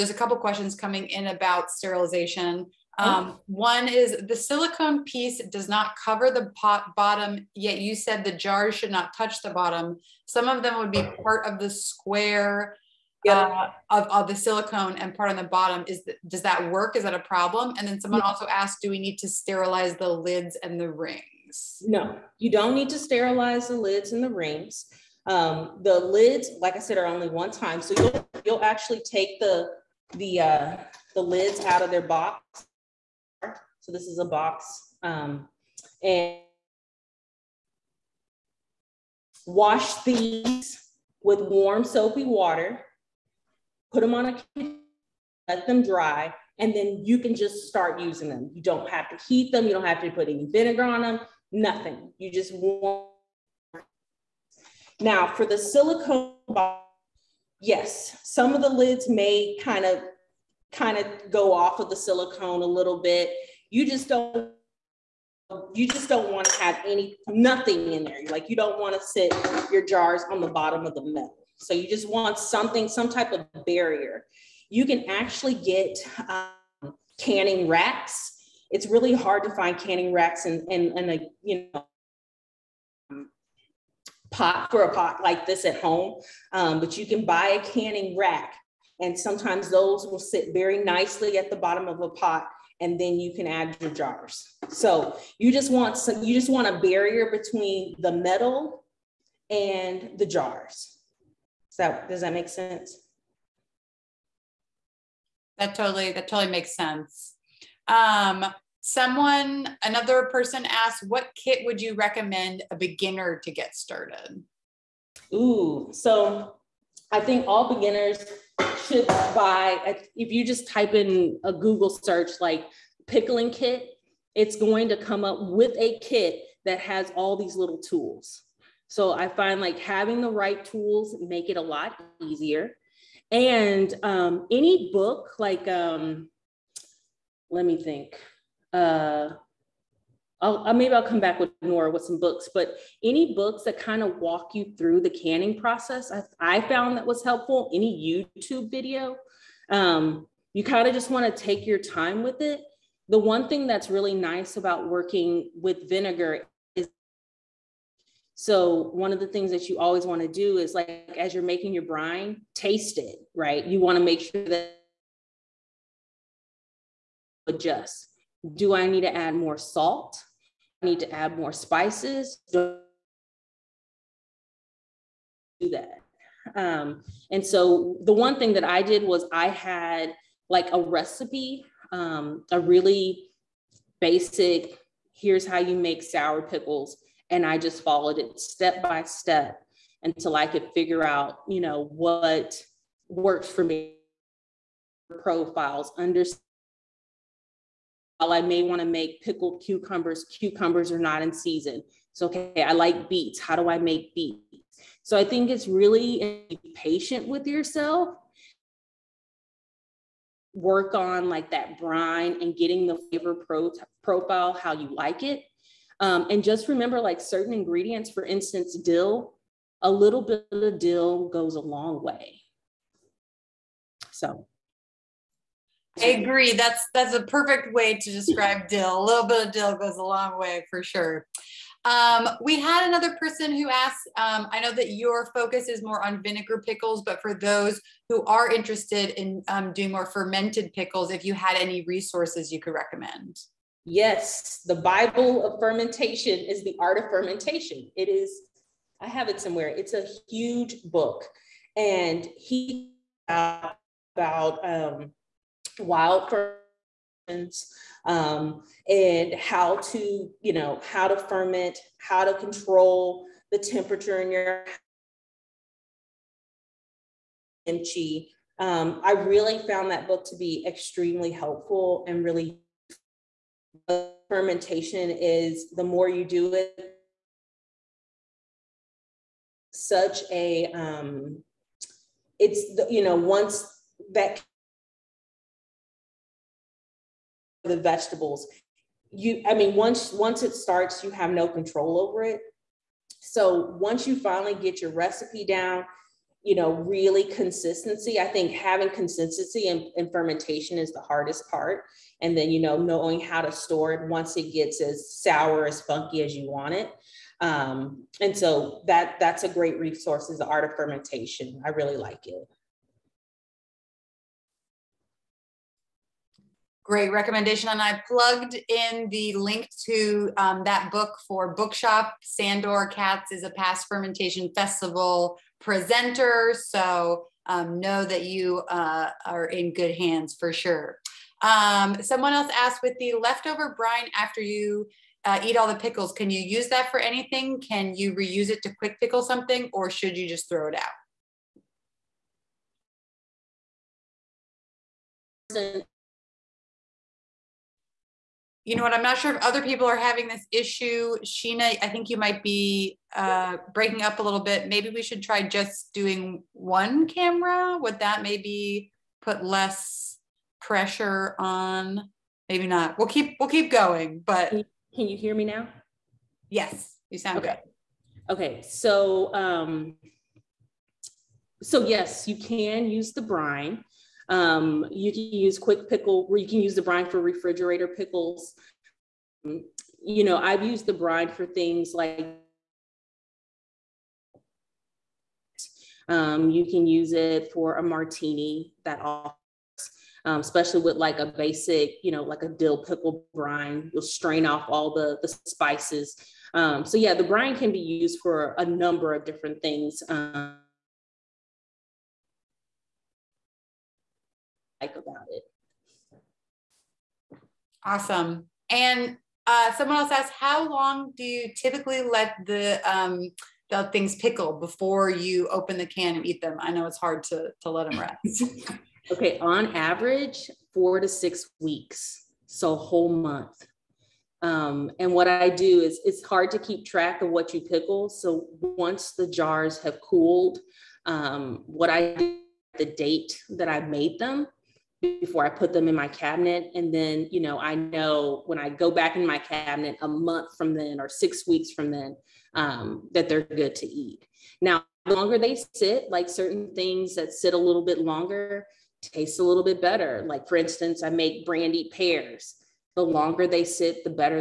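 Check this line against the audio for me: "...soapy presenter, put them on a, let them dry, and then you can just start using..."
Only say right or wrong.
wrong.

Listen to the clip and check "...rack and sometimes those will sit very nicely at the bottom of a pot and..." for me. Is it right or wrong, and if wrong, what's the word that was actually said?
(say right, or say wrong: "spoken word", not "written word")
right.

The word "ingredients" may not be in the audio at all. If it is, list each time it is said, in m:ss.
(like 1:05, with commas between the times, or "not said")
3:37.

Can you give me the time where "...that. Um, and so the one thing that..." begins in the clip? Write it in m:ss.
2:55.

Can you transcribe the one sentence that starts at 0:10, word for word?
Some of them would be part of the square yeah.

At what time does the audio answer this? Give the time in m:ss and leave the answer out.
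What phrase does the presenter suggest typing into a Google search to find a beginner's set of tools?
2:03.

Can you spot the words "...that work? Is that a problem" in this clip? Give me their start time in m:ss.
0:16.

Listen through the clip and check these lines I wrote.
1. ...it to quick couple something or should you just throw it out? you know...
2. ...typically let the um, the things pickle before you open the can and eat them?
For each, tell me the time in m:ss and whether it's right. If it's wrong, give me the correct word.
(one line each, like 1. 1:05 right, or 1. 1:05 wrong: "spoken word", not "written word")
1. 5:38 wrong: "pickle", not "couple"
2. 6:51 right.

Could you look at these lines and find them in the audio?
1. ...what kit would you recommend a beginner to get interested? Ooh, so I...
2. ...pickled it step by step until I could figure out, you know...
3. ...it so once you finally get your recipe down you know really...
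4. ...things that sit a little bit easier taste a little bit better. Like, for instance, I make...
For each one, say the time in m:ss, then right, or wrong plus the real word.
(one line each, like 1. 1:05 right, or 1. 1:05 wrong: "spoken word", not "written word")
1. 1:51 wrong: "started", not "interested"
2. 3:07 wrong: "followed", not "pickled"
3. 4:52 right
4. 7:26 wrong: "longer", not "easier".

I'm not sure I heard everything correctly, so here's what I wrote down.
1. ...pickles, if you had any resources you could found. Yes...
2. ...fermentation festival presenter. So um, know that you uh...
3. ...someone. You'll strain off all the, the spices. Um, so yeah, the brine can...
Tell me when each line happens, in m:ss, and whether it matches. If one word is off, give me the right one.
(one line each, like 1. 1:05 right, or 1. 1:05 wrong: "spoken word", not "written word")
1. 4:00 wrong: "recommend", not "found"
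2. 5:23 right
3. 6:33 wrong: "brine", not "someone".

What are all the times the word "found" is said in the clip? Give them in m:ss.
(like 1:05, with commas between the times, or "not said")
2:26, 4:29.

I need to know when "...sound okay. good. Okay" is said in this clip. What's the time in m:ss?
6:07.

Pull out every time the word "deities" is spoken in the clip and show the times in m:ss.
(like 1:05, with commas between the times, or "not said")
not said.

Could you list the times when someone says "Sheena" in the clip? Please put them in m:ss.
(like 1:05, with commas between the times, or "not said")
5:51.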